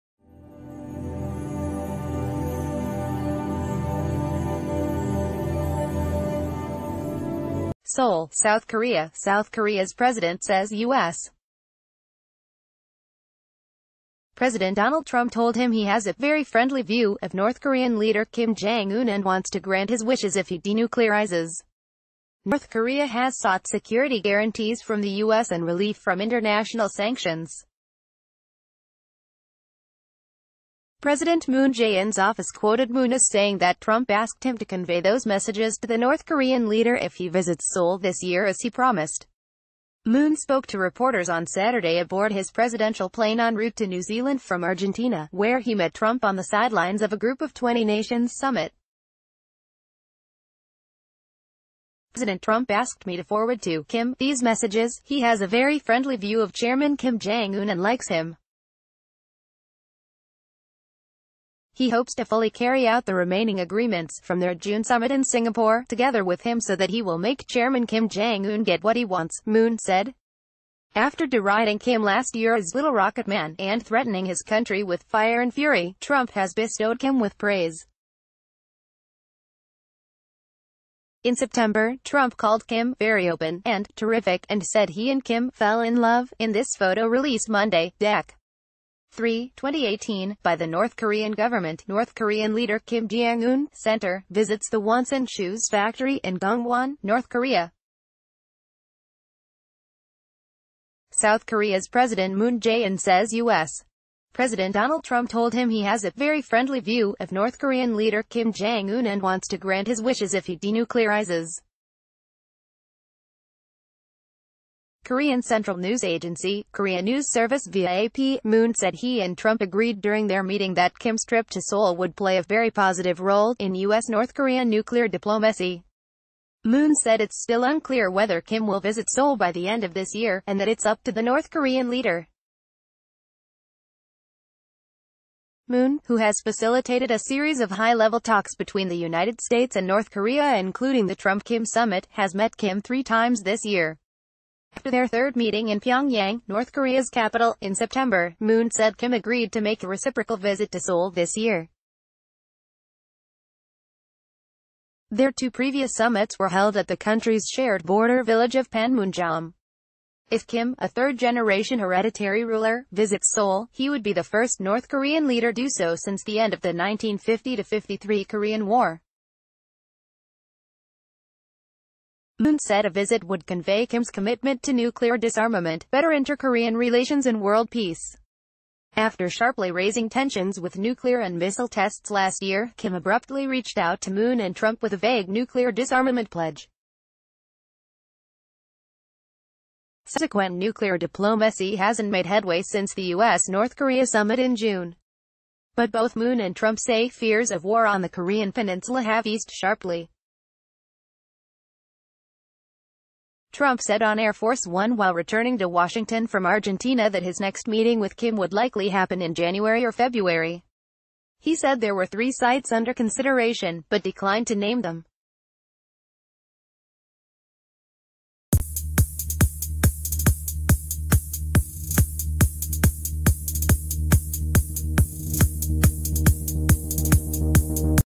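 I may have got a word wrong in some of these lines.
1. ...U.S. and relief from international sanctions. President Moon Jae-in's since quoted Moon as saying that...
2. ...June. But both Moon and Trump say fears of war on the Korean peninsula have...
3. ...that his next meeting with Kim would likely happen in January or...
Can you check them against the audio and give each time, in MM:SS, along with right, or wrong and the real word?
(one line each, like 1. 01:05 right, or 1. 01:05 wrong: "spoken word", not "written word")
1. 00:25 wrong: "office", not "since"
2. 03:14 right
3. 03:27 right.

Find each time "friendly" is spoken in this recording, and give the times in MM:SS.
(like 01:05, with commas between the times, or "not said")
00:16, 00:55, 01:46.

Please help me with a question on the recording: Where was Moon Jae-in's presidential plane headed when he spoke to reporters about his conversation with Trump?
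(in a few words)
New Zealand.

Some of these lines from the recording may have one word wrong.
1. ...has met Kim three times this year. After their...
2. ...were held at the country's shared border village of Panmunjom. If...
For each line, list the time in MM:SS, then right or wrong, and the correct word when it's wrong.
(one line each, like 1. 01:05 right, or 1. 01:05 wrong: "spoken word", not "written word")
1. 02:22 right
2. 02:36 right.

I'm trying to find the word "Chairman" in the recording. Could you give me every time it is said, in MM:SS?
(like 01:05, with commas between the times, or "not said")
00:56, 01:07.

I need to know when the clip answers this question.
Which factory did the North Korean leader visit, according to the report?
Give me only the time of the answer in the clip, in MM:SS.
01:34.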